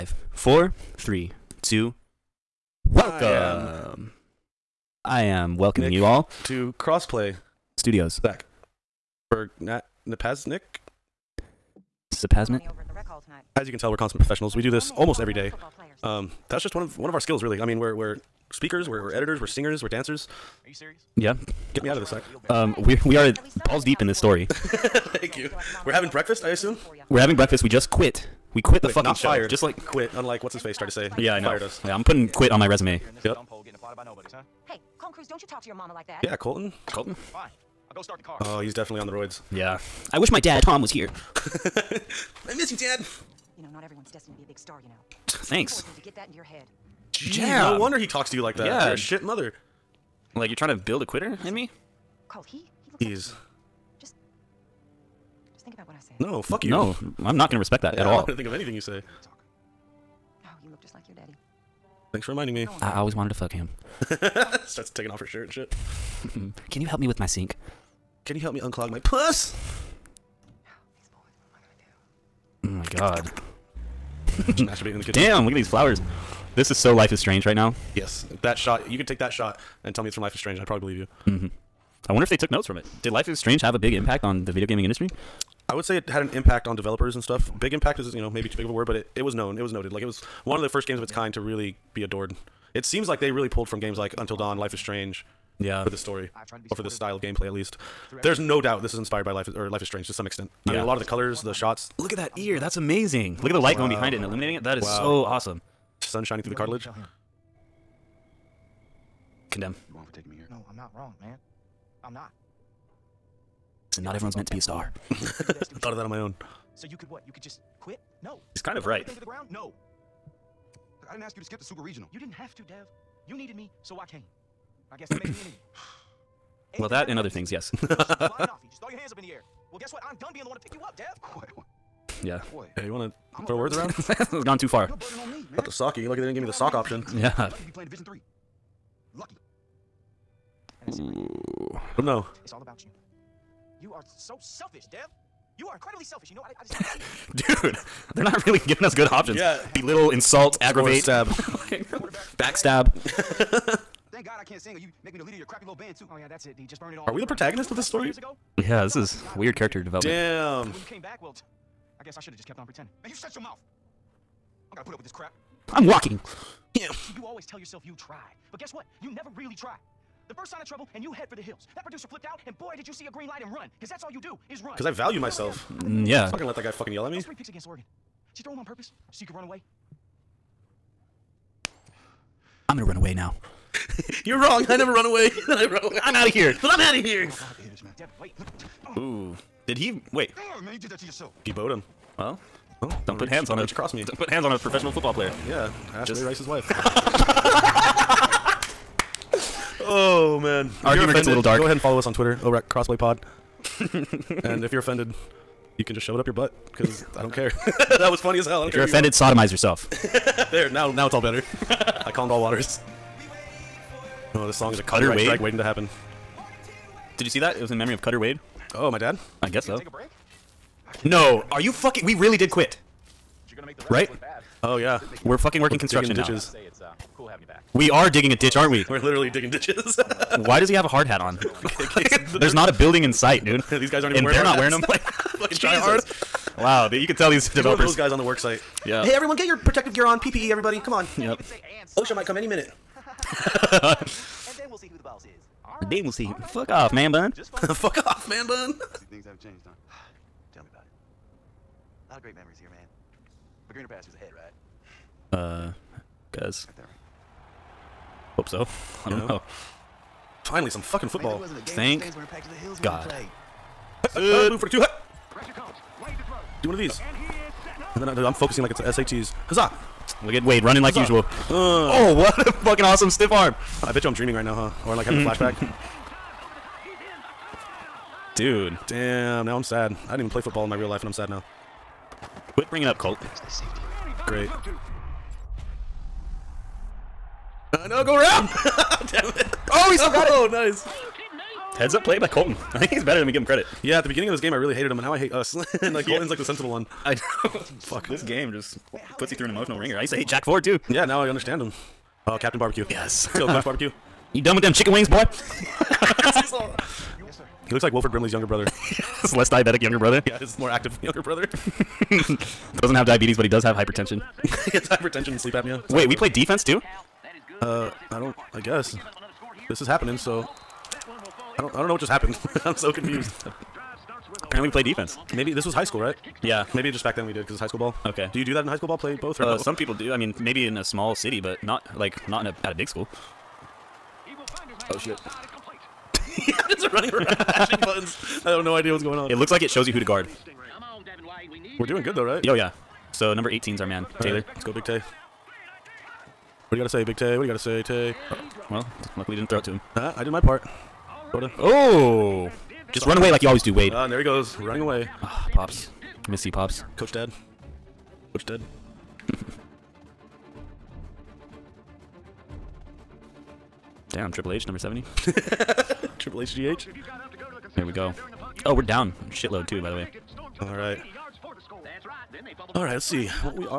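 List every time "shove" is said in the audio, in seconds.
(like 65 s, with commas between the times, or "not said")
206 s.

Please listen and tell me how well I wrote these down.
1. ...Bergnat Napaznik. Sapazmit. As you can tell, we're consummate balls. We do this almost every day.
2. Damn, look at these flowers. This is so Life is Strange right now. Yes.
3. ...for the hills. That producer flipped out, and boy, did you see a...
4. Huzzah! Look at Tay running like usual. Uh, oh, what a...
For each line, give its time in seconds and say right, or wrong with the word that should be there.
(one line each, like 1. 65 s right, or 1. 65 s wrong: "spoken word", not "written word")
1. 9 s wrong: "professionals", not "balls"
2. 75 s right
3. 171 s right
4. 269 s wrong: "Wade", not "Tay".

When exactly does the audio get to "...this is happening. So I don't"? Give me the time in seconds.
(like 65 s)
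319 s.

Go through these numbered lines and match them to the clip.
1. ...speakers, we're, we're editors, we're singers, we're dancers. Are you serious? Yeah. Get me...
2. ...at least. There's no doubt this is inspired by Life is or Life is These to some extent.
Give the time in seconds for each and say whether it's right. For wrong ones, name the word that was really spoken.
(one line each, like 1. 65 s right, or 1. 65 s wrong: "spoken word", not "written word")
1. 18 s right
2. 97 s wrong: "Strange", not "These".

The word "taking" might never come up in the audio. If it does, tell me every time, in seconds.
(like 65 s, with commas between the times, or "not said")
64 s, 110 s.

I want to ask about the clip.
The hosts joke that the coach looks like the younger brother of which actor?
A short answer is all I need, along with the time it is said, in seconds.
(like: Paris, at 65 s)
Wilford Brimley, at 307 s.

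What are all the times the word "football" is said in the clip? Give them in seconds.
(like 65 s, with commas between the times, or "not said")
194 s, 261 s, 280 s.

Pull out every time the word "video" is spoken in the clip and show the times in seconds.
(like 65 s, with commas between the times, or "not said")
84 s.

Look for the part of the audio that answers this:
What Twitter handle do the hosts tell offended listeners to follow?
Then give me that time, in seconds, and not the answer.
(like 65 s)
202 s.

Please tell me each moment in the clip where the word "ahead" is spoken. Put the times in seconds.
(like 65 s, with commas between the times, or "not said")
201 s, 254 s.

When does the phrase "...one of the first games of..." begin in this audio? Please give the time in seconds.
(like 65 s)
90 s.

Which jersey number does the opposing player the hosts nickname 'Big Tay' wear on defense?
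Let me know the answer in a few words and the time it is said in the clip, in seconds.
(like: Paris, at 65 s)
18, at 343 s.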